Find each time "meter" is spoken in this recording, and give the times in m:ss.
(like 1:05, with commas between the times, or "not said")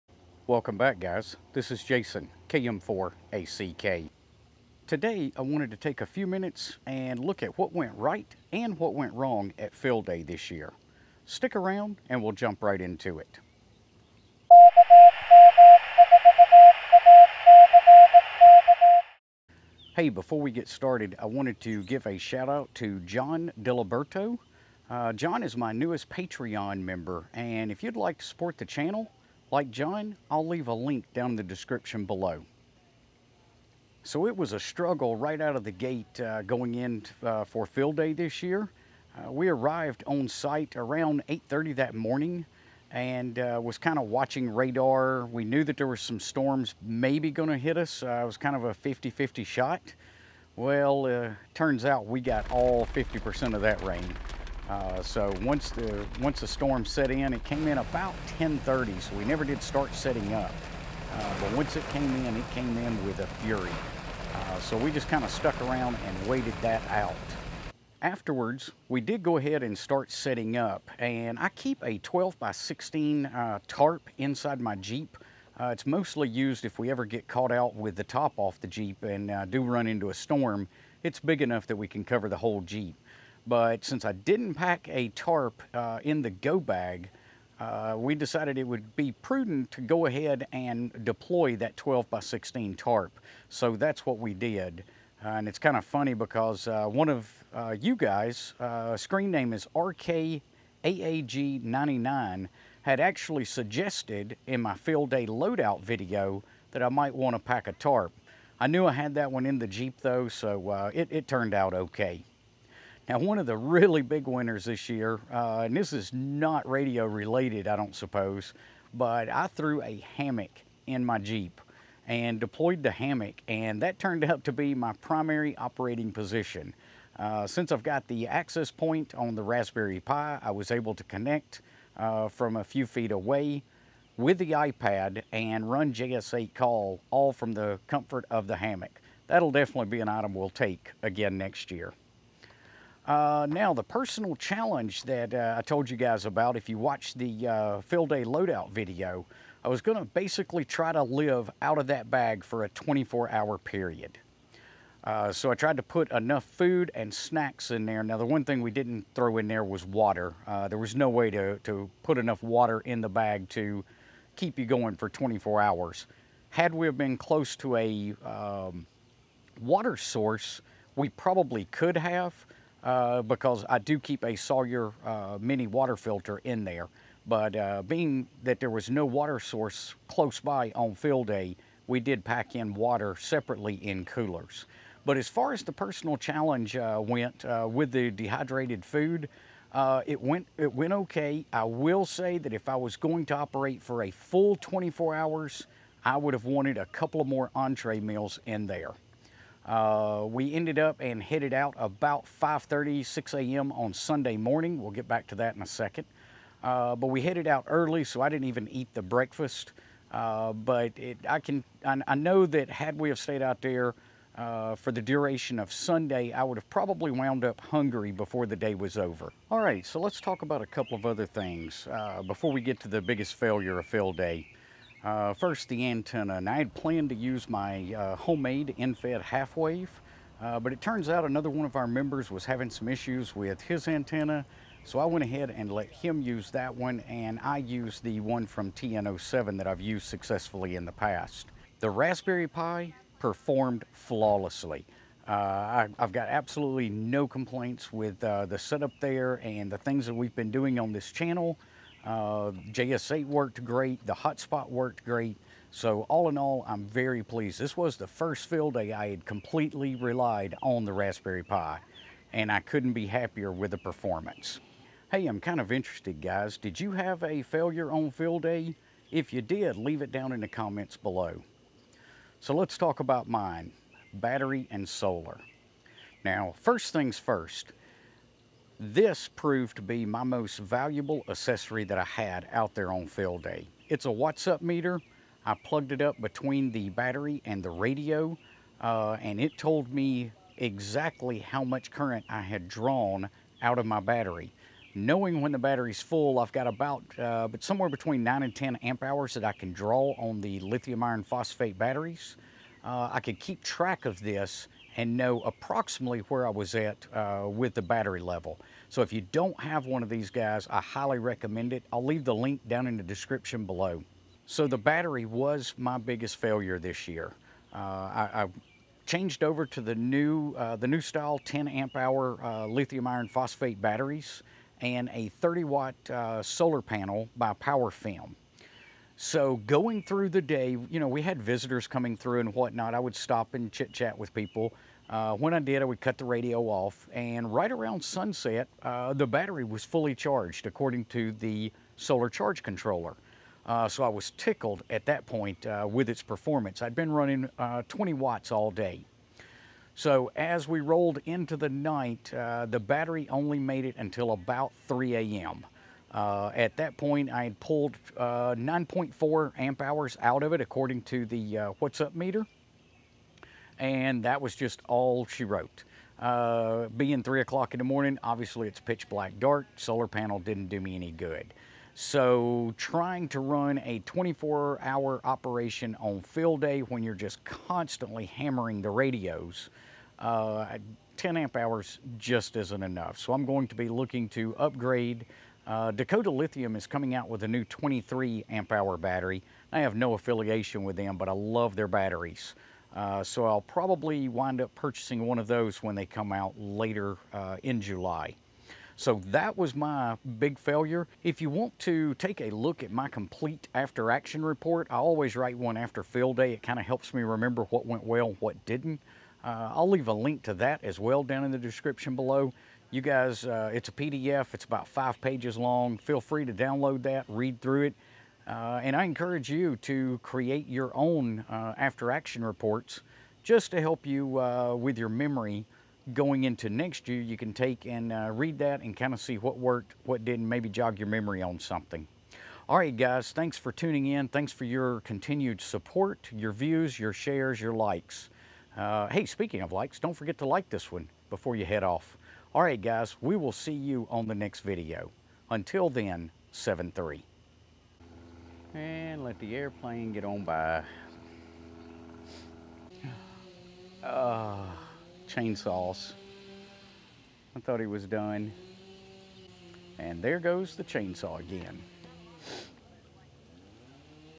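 4:44, 6:02.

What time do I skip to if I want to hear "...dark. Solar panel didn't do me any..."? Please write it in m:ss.
6:09.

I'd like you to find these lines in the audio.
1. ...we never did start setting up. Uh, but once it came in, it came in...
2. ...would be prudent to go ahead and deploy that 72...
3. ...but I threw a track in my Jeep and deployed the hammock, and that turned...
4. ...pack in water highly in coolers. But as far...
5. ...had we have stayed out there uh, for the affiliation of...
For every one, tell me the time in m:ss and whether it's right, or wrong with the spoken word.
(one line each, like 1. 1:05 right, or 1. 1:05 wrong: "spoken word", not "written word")
1. 0:59 right
2. 1:28 wrong: "12", not "72"
3. 1:58 wrong: "hammock", not "track"
4. 3:02 wrong: "separately", not "highly"
5. 3:32 wrong: "duration", not "affiliation".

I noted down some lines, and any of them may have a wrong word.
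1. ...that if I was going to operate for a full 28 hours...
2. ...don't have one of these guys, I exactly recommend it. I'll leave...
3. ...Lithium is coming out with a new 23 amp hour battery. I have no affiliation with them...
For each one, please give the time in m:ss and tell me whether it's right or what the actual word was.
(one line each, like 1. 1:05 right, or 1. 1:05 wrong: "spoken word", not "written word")
1. 3:12 wrong: "24", not "28"
2. 5:09 wrong: "highly", not "exactly"
3. 6:26 right.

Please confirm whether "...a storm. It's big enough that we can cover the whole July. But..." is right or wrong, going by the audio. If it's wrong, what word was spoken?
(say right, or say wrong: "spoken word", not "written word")
wrong: "Jeep", not "July".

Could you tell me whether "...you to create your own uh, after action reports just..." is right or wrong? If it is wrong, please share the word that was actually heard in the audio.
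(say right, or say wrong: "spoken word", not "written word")
right.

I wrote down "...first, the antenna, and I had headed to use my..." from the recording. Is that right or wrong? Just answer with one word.
wrong.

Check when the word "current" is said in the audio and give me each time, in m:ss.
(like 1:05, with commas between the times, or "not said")
4:51.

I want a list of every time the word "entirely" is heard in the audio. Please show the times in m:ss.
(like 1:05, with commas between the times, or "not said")
not said.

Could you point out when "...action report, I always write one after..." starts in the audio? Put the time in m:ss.
6:44.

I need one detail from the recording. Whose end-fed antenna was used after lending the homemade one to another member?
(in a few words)
TN07.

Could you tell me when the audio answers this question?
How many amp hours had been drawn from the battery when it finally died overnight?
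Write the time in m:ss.
5:58.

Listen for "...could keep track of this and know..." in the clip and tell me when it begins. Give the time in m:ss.
5:03.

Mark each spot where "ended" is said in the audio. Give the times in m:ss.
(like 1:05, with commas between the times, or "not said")
3:20.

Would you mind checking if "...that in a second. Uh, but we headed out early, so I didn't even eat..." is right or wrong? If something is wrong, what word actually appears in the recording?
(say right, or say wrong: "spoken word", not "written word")
right.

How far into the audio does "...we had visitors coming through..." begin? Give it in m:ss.
5:31.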